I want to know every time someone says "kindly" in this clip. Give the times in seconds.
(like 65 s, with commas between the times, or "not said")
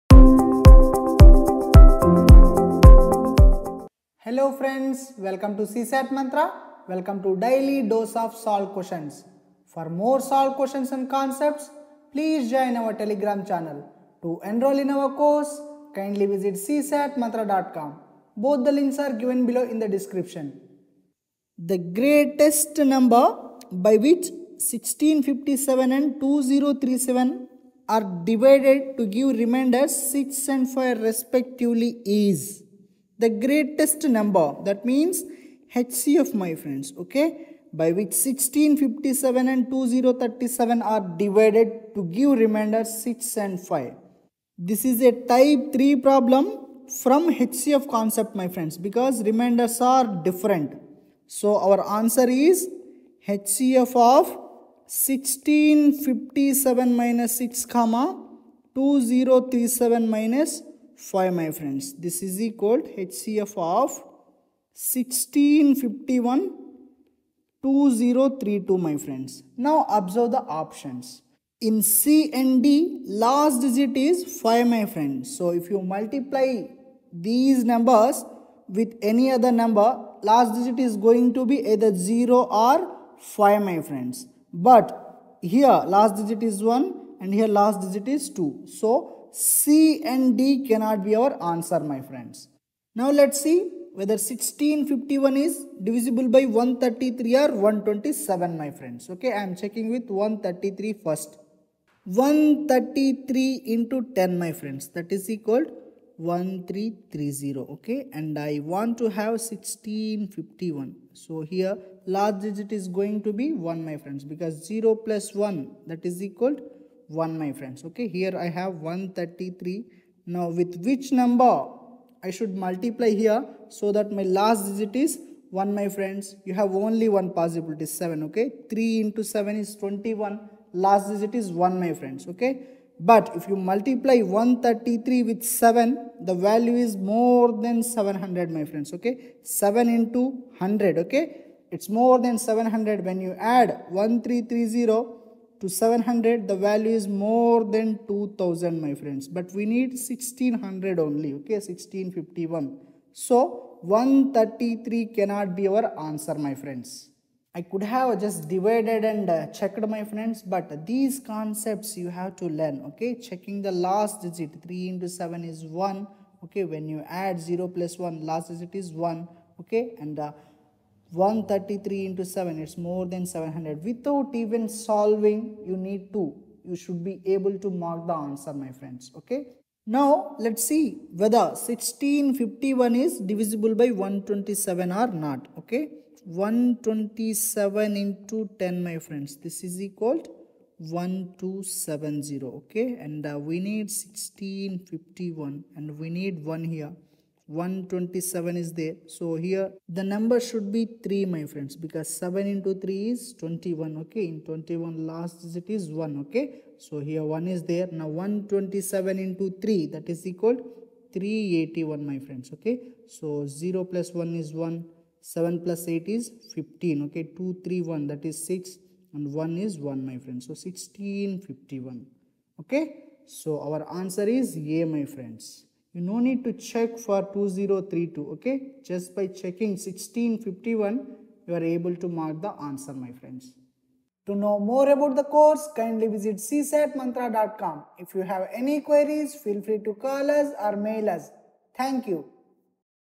15 s, 235 s.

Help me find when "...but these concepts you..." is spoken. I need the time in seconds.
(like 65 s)
160 s.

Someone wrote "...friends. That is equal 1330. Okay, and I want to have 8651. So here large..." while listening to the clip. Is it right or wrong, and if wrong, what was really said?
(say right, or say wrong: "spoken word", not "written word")
wrong: "1651", not "8651".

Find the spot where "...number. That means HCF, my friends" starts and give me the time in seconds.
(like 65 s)
34 s.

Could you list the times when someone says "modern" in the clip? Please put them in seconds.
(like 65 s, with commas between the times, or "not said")
not said.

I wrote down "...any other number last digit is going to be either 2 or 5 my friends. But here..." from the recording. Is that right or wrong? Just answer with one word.
wrong.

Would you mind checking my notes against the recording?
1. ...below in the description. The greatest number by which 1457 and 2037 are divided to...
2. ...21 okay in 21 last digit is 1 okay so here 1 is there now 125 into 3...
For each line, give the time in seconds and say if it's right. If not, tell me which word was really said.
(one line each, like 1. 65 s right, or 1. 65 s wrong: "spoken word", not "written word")
1. 19 s wrong: "1657", not "1457"
2. 203 s wrong: "127", not "125".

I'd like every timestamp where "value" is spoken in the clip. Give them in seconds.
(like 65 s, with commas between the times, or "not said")
136 s, 146 s.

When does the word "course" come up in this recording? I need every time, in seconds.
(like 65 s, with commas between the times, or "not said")
15 s, 235 s.